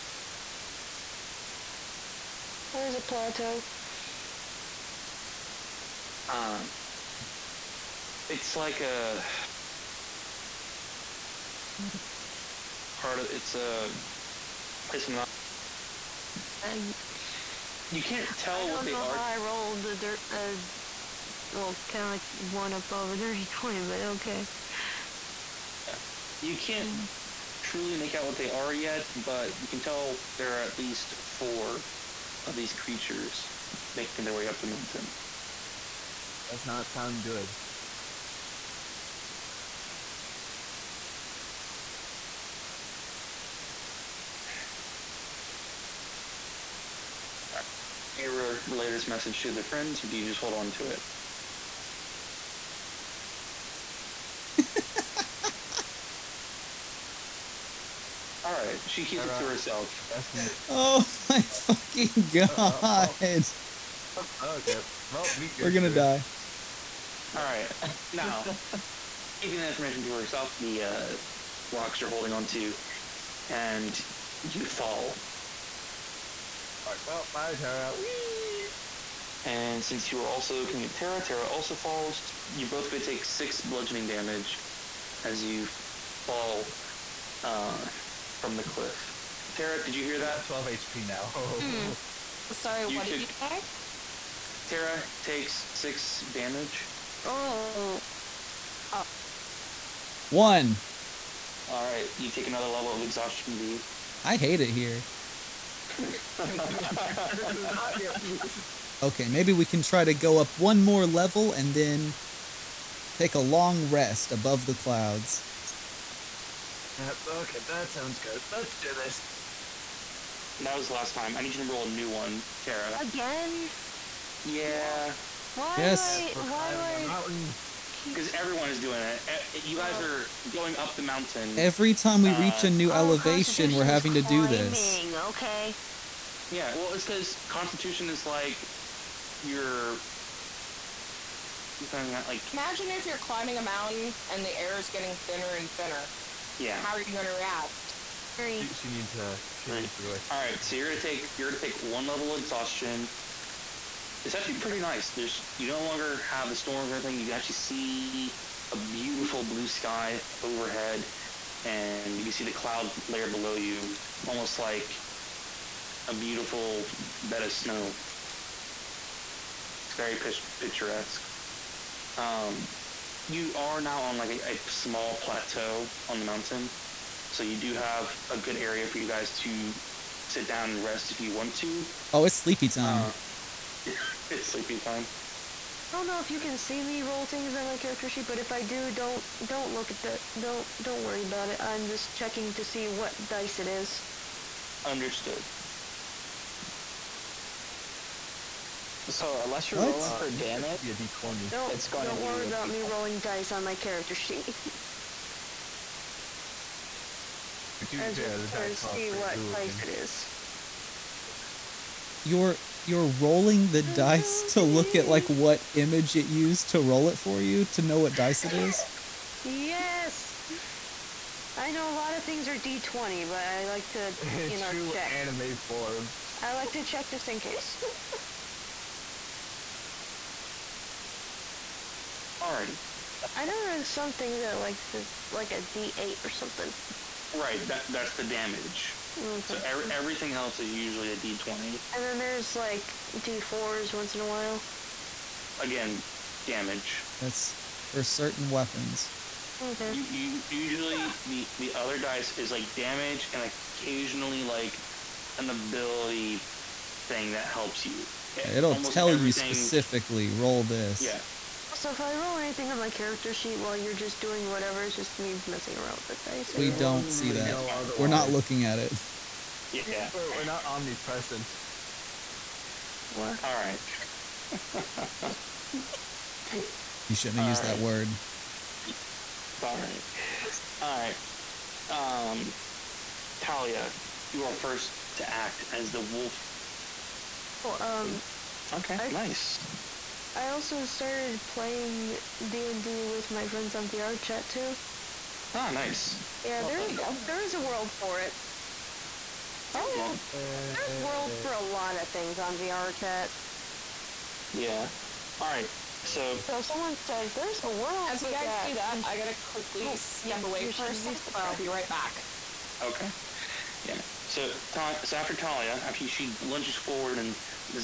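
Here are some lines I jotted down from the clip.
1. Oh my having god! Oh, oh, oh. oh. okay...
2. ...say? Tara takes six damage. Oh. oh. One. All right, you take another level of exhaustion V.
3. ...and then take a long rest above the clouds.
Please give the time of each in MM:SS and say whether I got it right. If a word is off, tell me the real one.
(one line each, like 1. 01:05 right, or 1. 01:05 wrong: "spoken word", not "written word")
1. 01:00 wrong: "fucking", not "having"
2. 01:33 right
3. 01:51 right.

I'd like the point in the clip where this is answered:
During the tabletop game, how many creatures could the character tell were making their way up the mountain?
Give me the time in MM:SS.
00:31.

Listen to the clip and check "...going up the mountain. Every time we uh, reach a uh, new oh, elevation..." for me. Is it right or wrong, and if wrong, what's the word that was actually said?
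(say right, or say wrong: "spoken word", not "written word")
right.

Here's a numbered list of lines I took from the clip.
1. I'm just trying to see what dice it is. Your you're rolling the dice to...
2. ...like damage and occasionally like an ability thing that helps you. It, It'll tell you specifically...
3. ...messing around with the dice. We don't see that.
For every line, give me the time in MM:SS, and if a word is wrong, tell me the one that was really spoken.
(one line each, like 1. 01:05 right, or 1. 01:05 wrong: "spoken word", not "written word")
1. 03:28 right
2. 04:12 right
3. 04:25 right.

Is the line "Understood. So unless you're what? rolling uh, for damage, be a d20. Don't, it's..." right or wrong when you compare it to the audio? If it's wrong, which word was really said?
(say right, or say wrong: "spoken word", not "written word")
right.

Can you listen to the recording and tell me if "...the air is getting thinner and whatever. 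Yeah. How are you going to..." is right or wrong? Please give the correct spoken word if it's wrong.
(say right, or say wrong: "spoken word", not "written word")
wrong: "thinner", not "whatever".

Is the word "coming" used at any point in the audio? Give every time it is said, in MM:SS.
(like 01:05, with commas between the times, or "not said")
01:20.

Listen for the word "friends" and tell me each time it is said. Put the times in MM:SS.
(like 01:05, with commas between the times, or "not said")
00:49, 04:53.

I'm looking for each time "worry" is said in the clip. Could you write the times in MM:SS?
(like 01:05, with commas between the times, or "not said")
03:11, 03:22.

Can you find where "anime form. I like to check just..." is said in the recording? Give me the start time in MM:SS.
03:45.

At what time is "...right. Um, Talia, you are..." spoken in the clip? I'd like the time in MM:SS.
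04:40.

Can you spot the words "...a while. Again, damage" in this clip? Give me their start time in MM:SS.
04:04.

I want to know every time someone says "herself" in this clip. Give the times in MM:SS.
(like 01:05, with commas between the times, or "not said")
00:59, 01:10.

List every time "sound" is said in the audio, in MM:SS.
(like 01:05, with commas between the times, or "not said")
00:36, 01:57.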